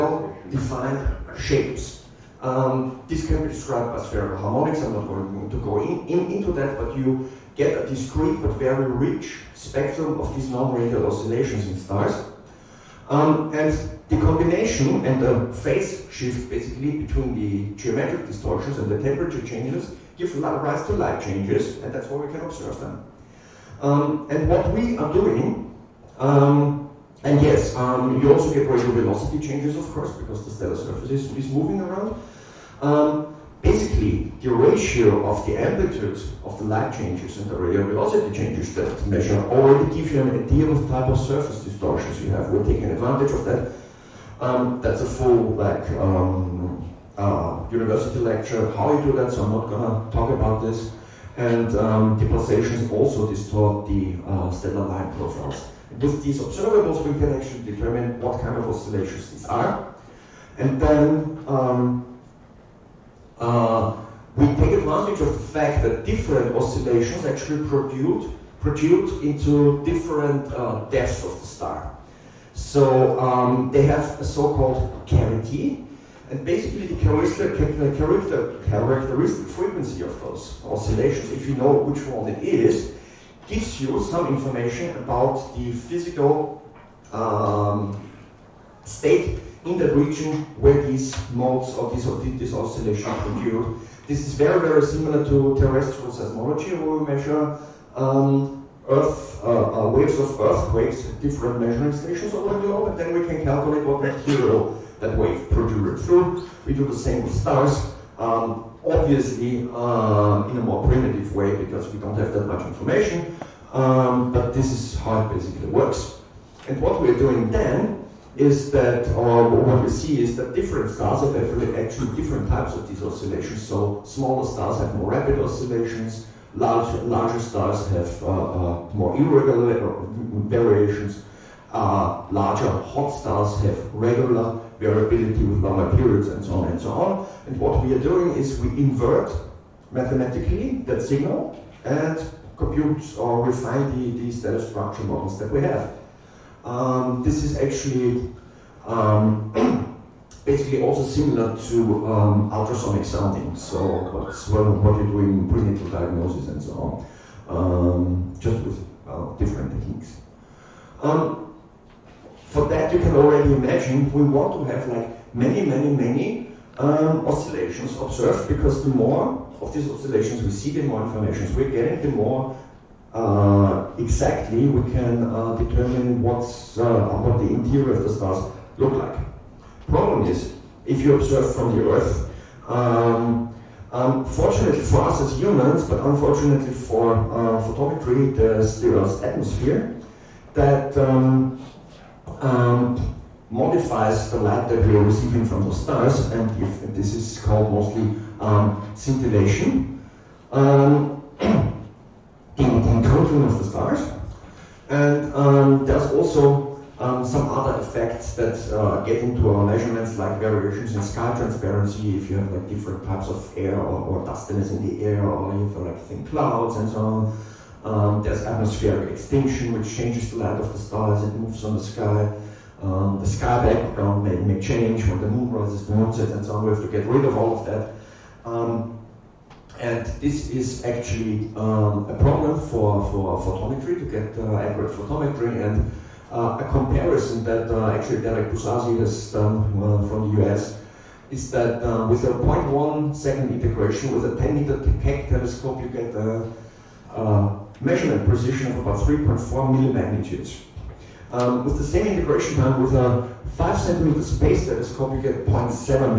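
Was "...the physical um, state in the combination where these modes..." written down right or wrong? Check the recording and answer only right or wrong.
wrong.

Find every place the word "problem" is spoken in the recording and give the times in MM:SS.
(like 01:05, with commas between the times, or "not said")
02:59, 03:52.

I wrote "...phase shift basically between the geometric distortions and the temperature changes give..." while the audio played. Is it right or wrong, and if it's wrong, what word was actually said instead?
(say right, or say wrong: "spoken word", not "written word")
right.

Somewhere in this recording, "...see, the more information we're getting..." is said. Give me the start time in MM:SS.
02:50.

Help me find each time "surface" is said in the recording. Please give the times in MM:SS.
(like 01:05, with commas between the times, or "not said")
00:30, 00:41.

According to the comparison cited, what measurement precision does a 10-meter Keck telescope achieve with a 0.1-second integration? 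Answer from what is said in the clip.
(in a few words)
3.4 millimagnitudes.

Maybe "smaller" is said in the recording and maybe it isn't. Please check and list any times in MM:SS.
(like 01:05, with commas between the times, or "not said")
02:04.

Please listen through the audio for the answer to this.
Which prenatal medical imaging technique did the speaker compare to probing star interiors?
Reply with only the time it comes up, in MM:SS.
02:32.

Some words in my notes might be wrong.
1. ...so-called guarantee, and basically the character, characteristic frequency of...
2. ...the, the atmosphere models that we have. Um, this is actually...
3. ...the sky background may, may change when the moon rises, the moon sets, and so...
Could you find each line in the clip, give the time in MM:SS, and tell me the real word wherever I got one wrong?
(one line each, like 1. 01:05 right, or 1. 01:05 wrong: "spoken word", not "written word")
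1. 01:14 right
2. 02:24 wrong: "structure", not "atmosphere"
3. 03:43 right.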